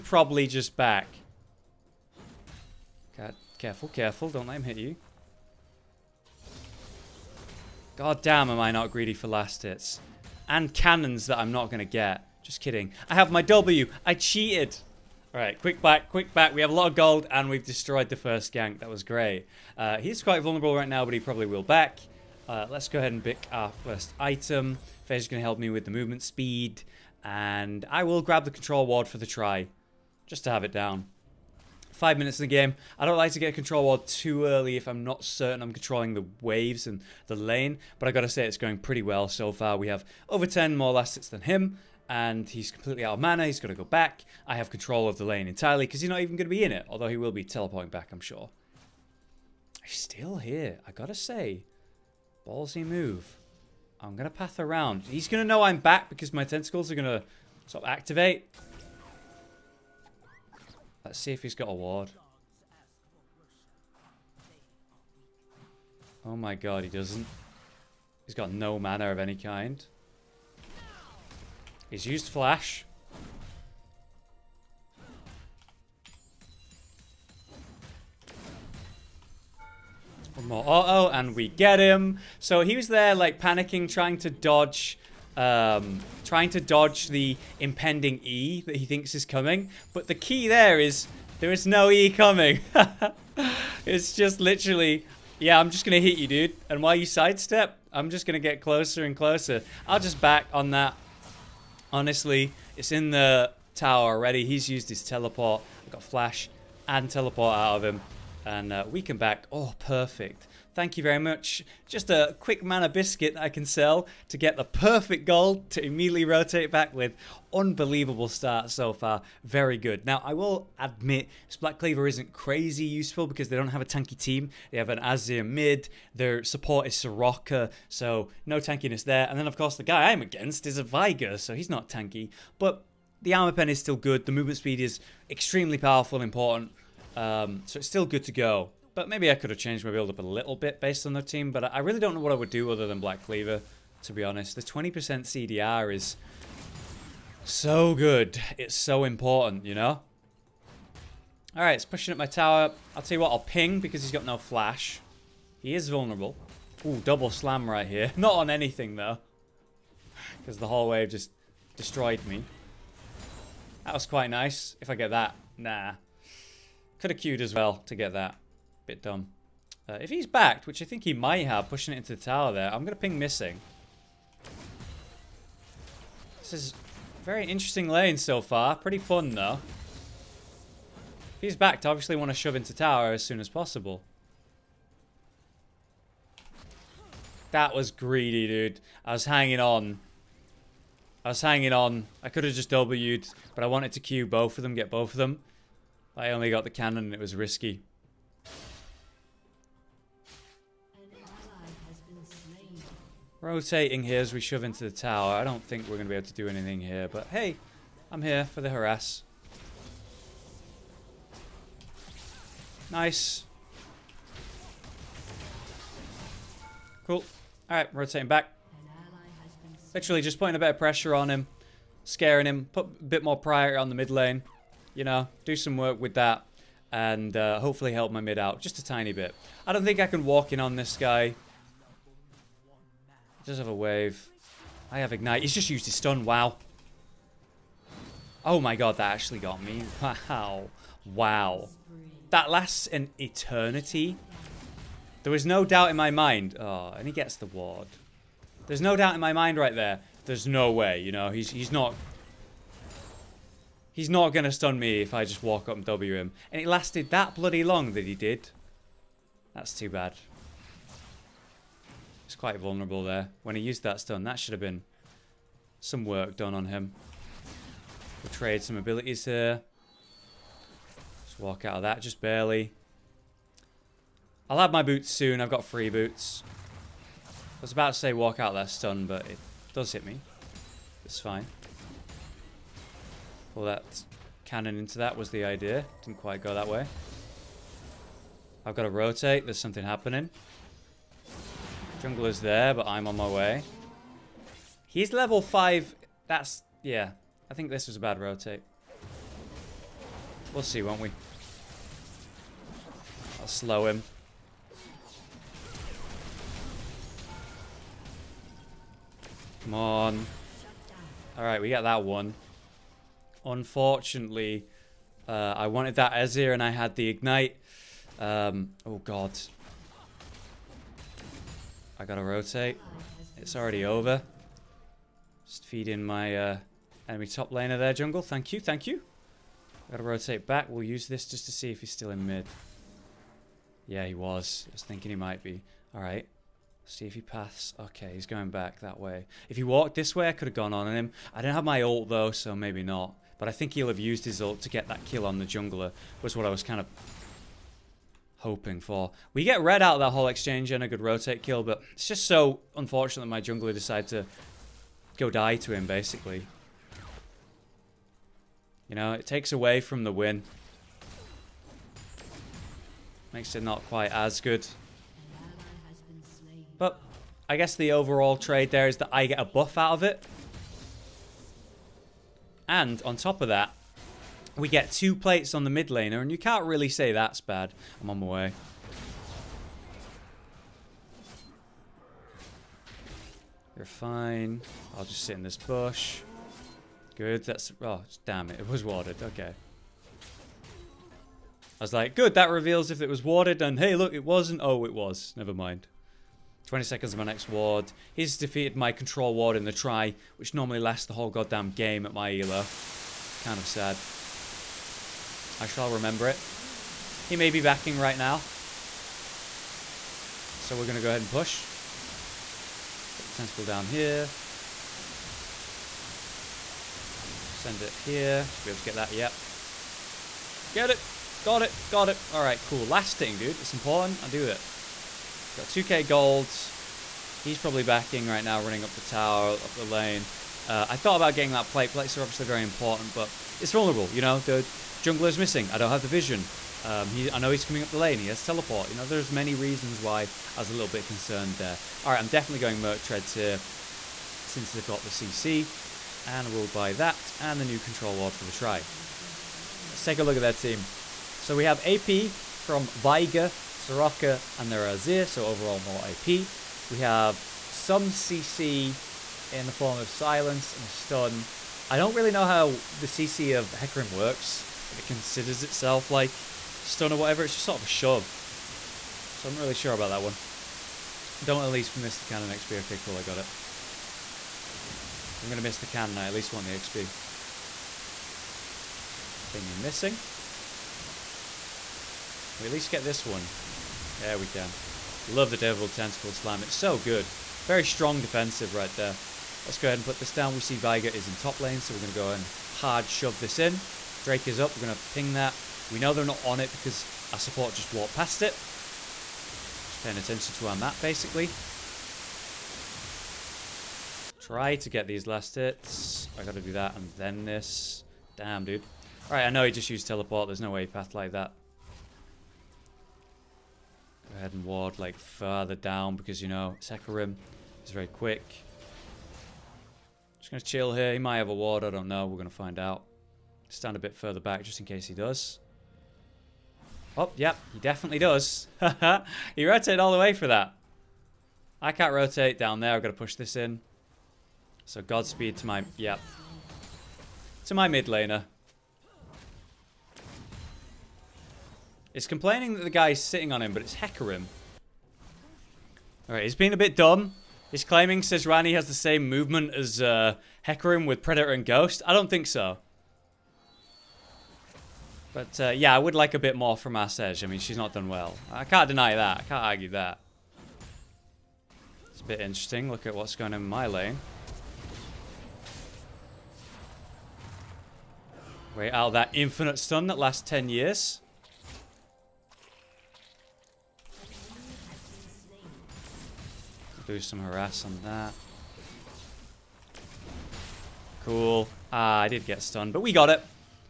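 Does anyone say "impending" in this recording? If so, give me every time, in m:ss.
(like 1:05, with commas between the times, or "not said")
1:27.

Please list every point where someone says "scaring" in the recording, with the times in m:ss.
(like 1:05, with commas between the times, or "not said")
3:42.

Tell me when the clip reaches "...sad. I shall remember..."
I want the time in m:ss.
6:43.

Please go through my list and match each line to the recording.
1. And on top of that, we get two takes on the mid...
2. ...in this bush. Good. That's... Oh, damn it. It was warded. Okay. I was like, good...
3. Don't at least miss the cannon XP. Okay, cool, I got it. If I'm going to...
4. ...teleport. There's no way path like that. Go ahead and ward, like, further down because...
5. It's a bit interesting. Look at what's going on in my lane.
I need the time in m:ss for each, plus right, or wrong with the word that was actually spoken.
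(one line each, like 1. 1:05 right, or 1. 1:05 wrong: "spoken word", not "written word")
1. 6:12 wrong: "plates", not "takes"
2. 6:25 right
3. 7:51 right
4. 8:30 right
5. 9:22 right.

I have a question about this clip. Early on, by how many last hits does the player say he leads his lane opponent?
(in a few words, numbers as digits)
Over 10.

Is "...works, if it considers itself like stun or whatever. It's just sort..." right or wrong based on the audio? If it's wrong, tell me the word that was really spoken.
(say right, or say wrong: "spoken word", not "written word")
right.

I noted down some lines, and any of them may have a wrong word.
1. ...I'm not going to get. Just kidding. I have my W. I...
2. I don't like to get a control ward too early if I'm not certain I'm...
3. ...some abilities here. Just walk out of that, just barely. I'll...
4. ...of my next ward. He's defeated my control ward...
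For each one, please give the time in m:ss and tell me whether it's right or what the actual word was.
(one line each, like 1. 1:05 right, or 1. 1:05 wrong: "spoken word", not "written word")
1. 0:11 right
2. 0:32 right
3. 4:28 right
4. 6:37 right.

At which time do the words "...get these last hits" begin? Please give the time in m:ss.
8:24.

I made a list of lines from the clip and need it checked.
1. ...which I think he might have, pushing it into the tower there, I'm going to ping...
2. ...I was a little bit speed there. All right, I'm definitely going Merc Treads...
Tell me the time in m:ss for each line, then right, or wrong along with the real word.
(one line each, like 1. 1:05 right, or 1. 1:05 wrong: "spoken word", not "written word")
1. 2:50 right
2. 7:20 wrong: "concerned", not "speed".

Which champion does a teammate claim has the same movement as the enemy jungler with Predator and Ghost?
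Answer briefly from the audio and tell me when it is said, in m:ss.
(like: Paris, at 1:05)
Sejuani, at 9:08.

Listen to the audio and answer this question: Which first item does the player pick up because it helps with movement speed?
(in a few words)
Fez.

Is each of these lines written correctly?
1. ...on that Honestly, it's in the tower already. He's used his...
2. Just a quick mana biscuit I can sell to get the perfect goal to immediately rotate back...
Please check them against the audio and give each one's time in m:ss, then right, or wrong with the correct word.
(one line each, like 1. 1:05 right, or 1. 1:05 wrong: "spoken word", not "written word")
1. 1:40 right
2. 1:51 right.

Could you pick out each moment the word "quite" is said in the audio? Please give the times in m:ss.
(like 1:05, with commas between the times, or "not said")
0:20, 2:44, 4:22, 4:46, 6:03.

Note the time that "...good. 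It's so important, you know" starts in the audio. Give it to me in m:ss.
2:27.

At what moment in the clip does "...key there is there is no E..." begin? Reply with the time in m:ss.
1:30.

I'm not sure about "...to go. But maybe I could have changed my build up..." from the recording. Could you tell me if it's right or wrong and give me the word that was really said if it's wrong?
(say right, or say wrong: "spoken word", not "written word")
right.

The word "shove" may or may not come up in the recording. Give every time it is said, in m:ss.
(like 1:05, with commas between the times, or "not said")
3:02, 3:24, 7:47, 8:13.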